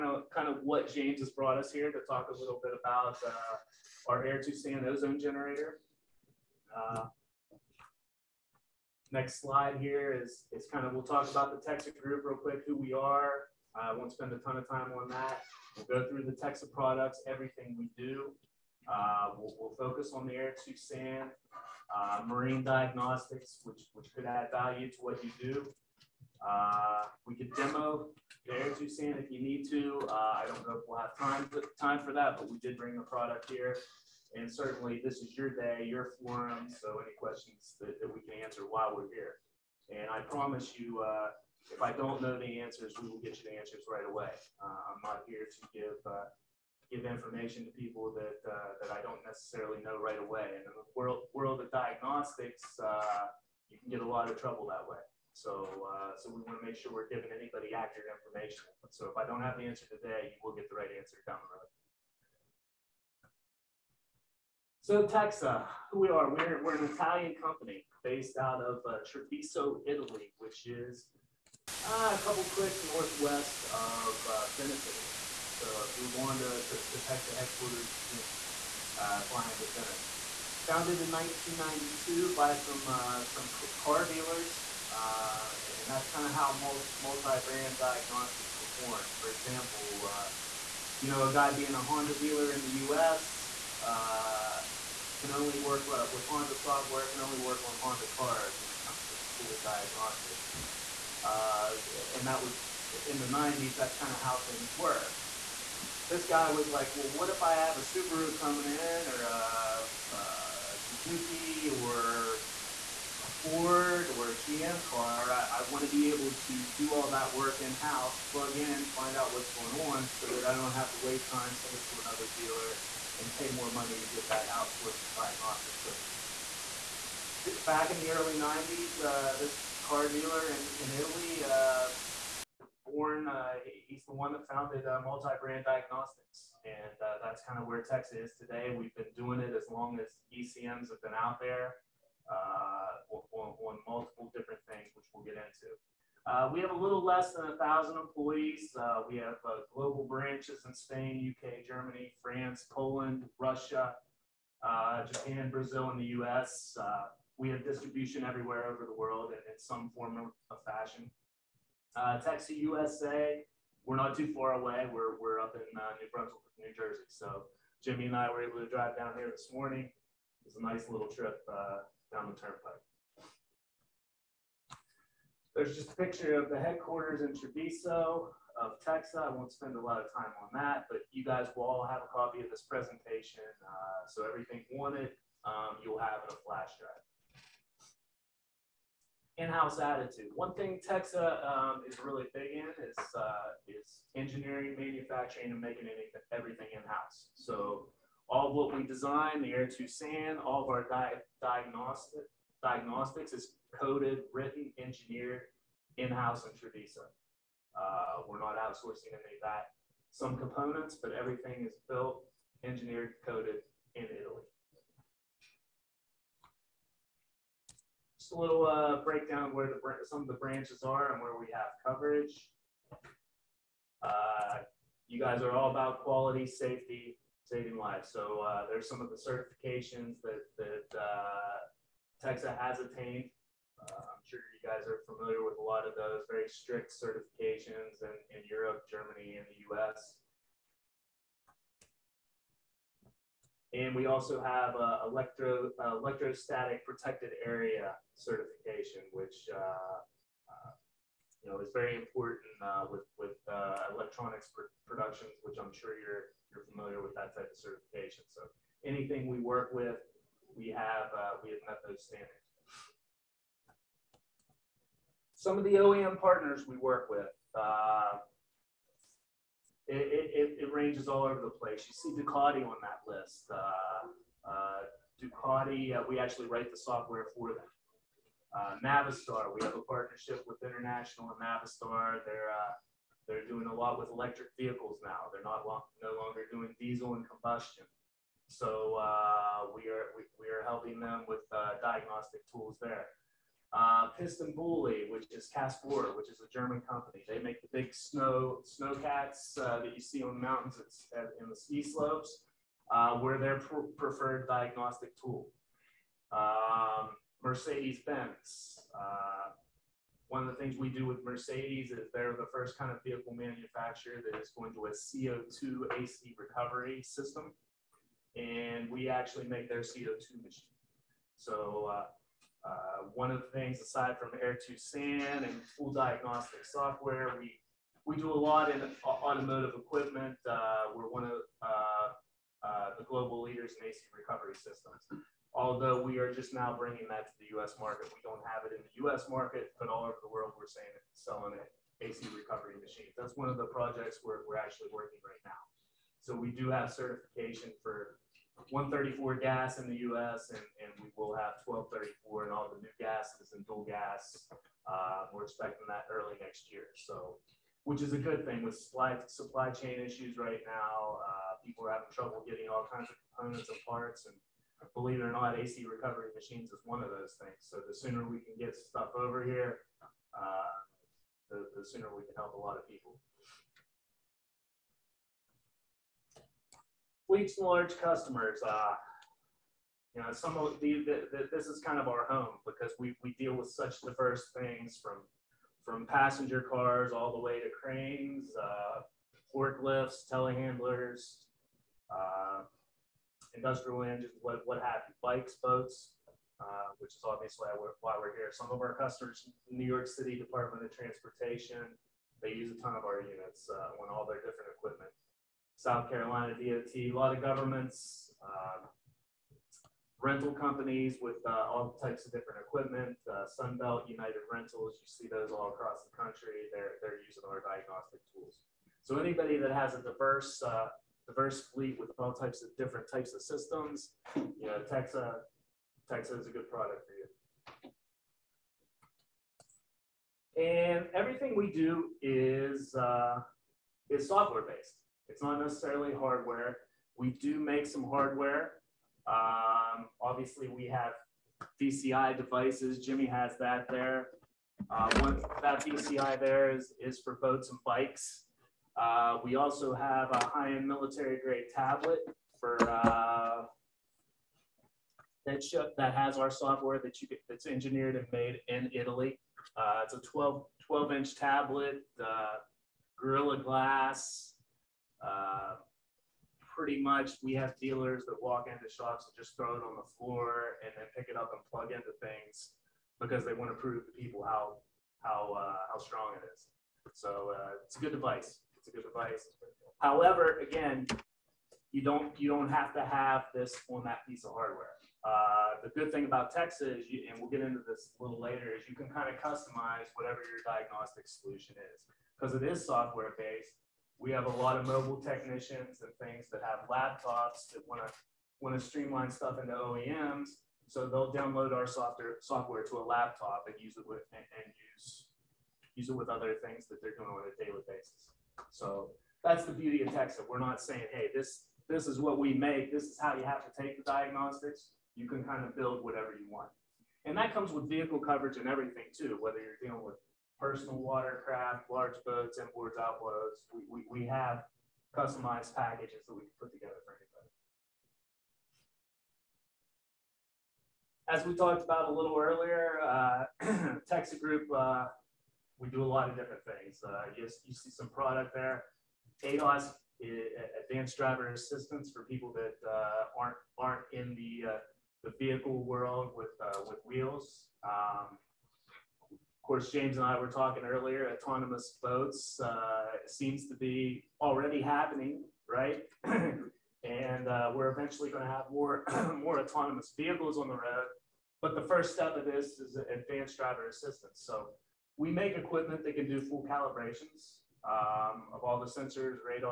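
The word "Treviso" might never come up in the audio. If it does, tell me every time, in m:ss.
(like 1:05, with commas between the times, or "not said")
1:09, 2:57, 3:26.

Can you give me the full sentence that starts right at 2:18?
We've been doing it as long as ECMs have been out there.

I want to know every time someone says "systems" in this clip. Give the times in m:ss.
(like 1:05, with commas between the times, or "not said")
5:17, 5:34, 7:03.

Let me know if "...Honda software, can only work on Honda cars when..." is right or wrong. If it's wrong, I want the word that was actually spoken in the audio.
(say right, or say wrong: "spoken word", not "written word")
right.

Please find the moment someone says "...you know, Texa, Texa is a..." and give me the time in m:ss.
7:04.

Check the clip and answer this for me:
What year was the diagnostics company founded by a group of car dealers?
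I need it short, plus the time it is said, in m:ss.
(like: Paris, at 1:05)
1992, at 1:21.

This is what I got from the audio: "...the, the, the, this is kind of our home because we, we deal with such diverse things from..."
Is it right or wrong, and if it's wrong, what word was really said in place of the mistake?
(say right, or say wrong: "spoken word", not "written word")
right.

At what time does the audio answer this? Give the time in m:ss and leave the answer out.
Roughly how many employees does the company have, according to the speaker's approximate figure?
2:26.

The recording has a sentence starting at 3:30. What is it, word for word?
Some components, but everything is built, engineered, coded in Italy.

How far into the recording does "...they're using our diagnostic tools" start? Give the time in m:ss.
6:56.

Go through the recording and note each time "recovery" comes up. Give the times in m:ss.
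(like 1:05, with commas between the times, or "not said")
5:16, 5:34, 5:42, 6:05.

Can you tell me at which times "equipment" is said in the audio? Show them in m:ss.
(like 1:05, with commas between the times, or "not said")
5:29, 6:44, 6:52, 9:25.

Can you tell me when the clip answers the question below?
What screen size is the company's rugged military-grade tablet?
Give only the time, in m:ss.
7:40.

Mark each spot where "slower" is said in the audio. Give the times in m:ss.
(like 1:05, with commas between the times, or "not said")
not said.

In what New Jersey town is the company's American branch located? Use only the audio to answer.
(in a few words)
New Brunswick.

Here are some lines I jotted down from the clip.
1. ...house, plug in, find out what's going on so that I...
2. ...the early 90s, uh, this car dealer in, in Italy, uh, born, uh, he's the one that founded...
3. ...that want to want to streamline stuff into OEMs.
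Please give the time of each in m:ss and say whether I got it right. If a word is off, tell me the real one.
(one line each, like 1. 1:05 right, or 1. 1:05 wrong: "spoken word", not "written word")
1. 1:57 right
2. 2:07 right
3. 8:17 right.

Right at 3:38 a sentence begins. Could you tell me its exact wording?
Just a little uh, breakdown of where the some of the branches are and where we have coverage.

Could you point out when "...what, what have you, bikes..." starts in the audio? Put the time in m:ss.
6:34.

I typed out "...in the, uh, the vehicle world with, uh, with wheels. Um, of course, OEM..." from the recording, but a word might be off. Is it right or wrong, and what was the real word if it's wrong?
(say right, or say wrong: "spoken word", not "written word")
wrong: "James", not "OEM".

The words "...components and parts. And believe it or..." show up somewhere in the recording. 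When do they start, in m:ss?
6:03.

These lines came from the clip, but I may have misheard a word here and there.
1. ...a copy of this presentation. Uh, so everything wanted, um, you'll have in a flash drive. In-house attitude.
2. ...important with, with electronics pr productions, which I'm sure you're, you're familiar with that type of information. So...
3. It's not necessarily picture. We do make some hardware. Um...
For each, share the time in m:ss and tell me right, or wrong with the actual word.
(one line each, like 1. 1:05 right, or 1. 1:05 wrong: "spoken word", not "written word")
1. 3:02 right
2. 4:11 wrong: "certification", not "information"
3. 7:15 wrong: "hardware", not "picture".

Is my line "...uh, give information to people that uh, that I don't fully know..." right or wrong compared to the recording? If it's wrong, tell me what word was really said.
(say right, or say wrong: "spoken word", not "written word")
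wrong: "necessarily", not "fully".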